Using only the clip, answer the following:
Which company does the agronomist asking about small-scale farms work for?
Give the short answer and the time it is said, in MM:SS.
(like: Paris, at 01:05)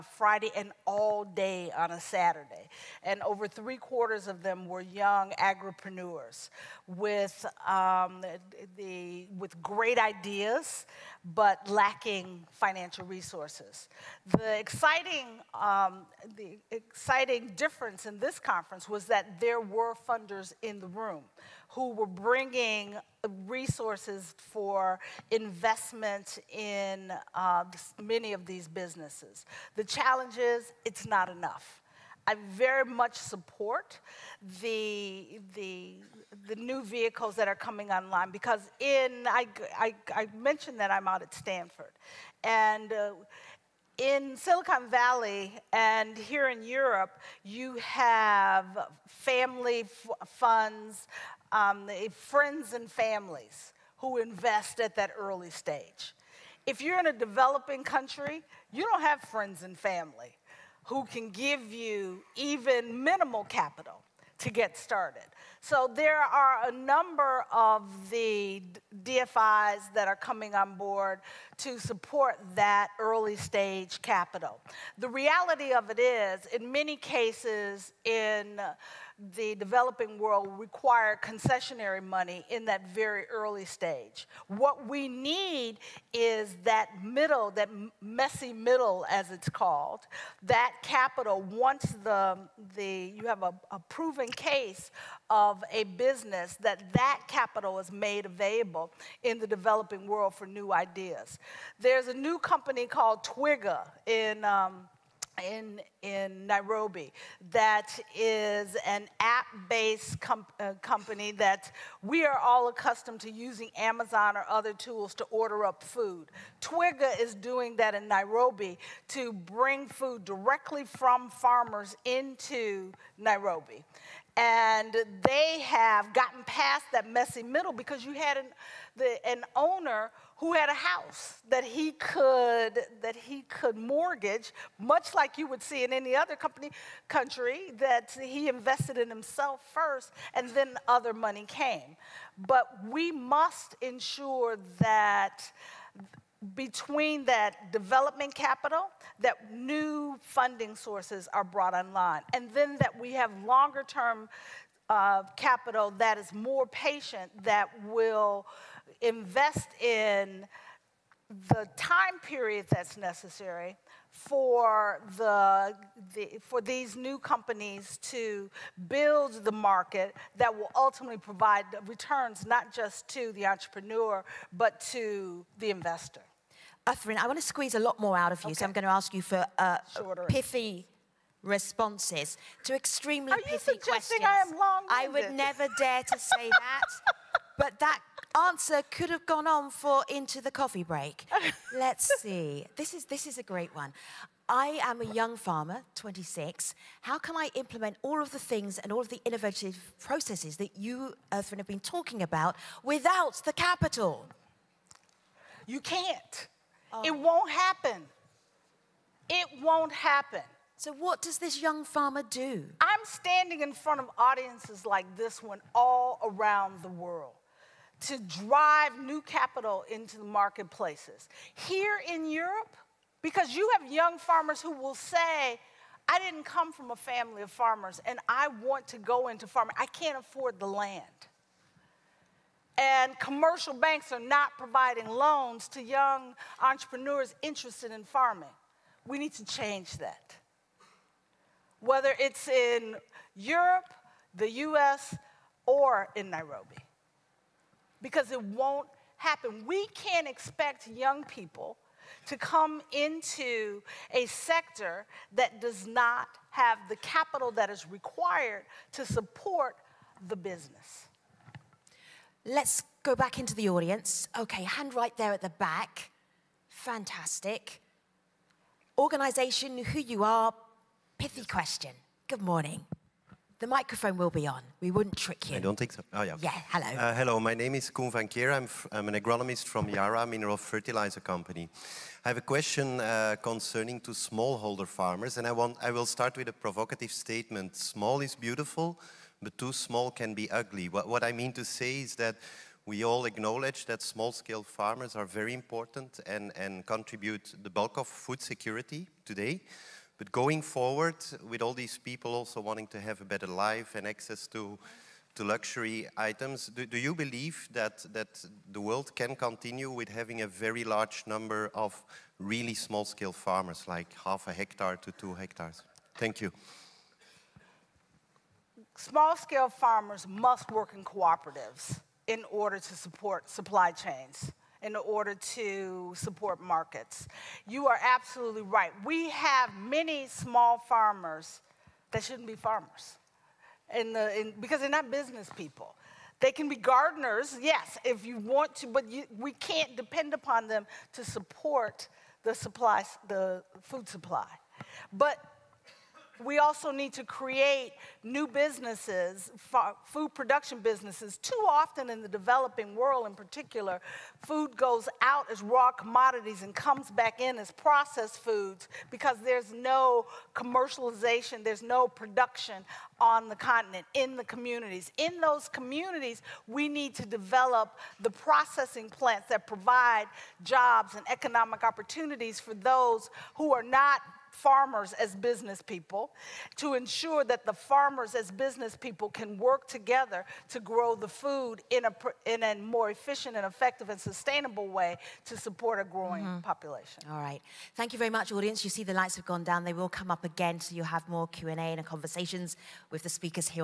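Yara, at 04:39.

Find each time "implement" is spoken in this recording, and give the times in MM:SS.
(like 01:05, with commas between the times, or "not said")
03:17.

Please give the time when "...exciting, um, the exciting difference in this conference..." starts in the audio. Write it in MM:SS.
00:14.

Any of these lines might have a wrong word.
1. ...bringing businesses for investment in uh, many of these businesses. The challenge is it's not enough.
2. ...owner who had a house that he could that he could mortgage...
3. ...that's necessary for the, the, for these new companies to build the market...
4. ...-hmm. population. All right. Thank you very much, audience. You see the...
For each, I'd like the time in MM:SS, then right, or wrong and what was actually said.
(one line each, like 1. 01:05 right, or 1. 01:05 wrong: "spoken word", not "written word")
1. 00:22 wrong: "resources", not "businesses"
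2. 02:09 right
3. 02:42 right
4. 06:26 right.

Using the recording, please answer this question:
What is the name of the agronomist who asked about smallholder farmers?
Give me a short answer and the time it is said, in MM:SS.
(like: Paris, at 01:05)
Koen van Keer, at 04:37.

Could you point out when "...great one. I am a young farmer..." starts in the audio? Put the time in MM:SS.
03:13.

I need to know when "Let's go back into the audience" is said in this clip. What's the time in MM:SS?
04:22.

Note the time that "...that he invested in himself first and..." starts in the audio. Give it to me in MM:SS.
02:17.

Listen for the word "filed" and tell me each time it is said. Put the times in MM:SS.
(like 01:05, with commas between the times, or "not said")
not said.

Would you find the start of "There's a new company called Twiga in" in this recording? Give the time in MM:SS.
01:41.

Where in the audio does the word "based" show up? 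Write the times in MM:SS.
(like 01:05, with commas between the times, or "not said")
01:49.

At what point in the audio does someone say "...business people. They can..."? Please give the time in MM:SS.
05:35.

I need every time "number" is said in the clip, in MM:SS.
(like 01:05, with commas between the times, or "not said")
01:06, 05:11.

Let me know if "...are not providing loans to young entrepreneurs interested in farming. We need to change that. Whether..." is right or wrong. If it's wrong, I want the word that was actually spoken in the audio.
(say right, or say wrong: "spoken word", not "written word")
right.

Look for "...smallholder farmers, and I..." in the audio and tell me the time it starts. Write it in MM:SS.
04:44.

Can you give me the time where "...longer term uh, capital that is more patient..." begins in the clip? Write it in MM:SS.
02:33.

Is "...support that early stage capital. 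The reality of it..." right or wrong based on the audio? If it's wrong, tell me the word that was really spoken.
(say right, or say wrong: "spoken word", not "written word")
right.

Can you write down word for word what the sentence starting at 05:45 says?
But we also need to create new businesses, food production businesses.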